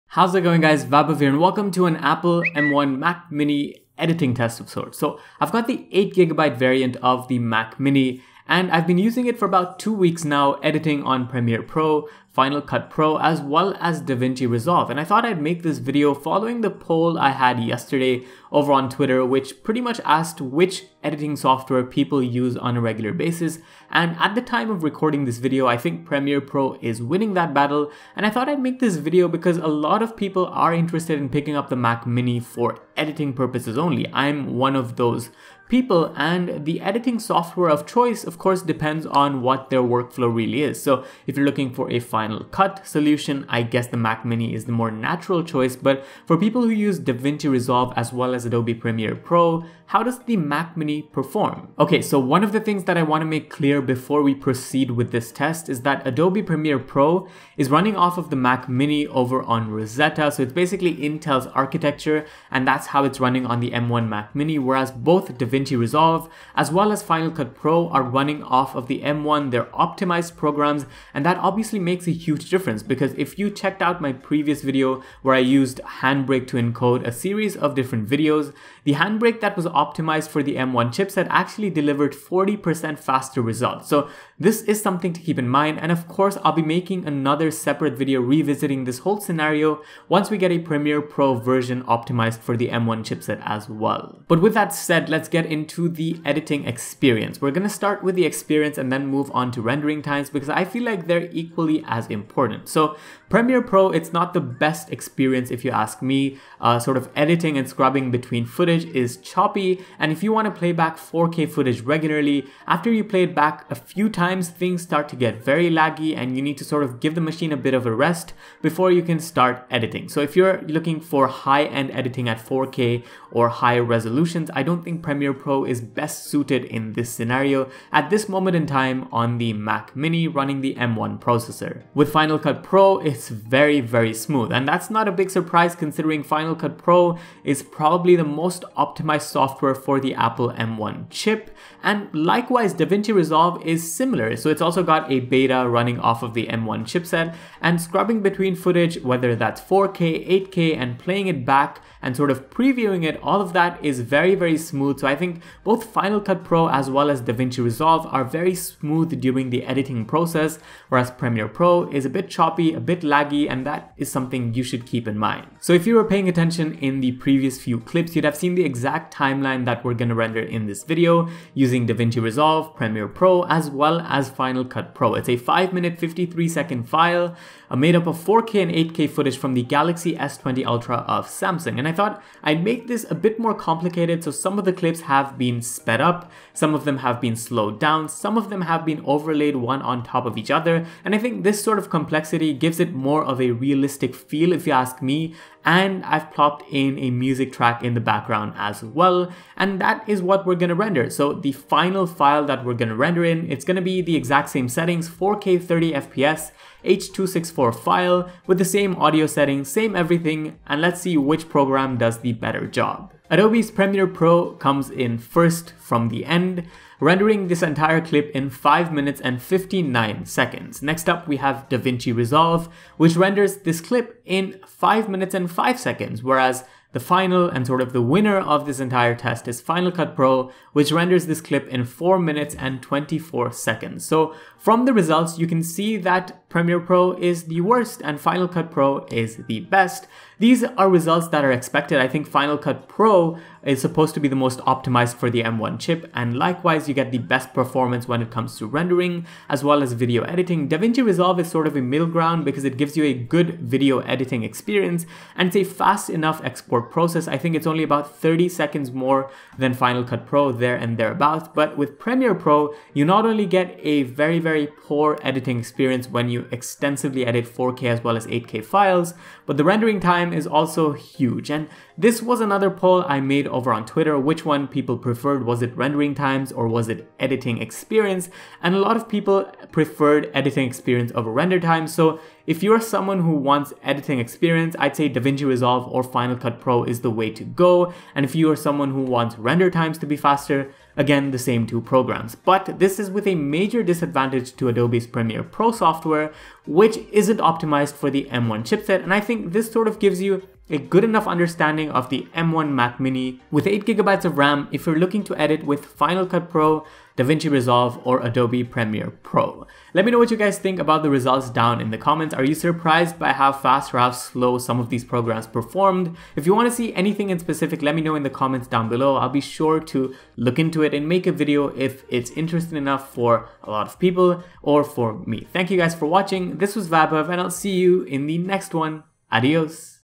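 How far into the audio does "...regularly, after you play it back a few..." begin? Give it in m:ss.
1:51.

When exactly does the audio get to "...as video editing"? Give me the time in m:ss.
4:09.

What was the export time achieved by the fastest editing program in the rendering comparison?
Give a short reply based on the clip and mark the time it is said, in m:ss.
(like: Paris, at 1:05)
4 minutes and 24 seconds, at 3:51.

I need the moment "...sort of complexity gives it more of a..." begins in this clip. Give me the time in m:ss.
3:11.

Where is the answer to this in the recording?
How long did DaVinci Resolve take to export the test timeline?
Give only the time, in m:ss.
3:44.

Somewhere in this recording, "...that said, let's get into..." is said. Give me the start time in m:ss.
1:34.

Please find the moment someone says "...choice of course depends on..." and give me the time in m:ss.
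0:37.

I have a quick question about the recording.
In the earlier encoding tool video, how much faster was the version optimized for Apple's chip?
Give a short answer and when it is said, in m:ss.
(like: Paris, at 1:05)
40%, at 1:22.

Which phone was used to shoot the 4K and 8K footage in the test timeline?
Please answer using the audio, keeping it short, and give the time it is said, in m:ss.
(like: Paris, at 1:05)
Galaxy S20 Ultra, at 2:59.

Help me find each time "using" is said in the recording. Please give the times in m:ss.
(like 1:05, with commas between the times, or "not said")
0:08, 2:51.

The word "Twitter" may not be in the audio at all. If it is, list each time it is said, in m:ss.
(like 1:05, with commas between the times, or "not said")
0:18, 4:33.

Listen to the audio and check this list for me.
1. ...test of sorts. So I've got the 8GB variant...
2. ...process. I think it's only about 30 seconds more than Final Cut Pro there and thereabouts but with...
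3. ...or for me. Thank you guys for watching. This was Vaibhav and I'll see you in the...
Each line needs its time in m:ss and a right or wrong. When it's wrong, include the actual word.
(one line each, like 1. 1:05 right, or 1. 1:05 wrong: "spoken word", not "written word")
1. 0:04 right
2. 4:16 right
3. 5:24 right.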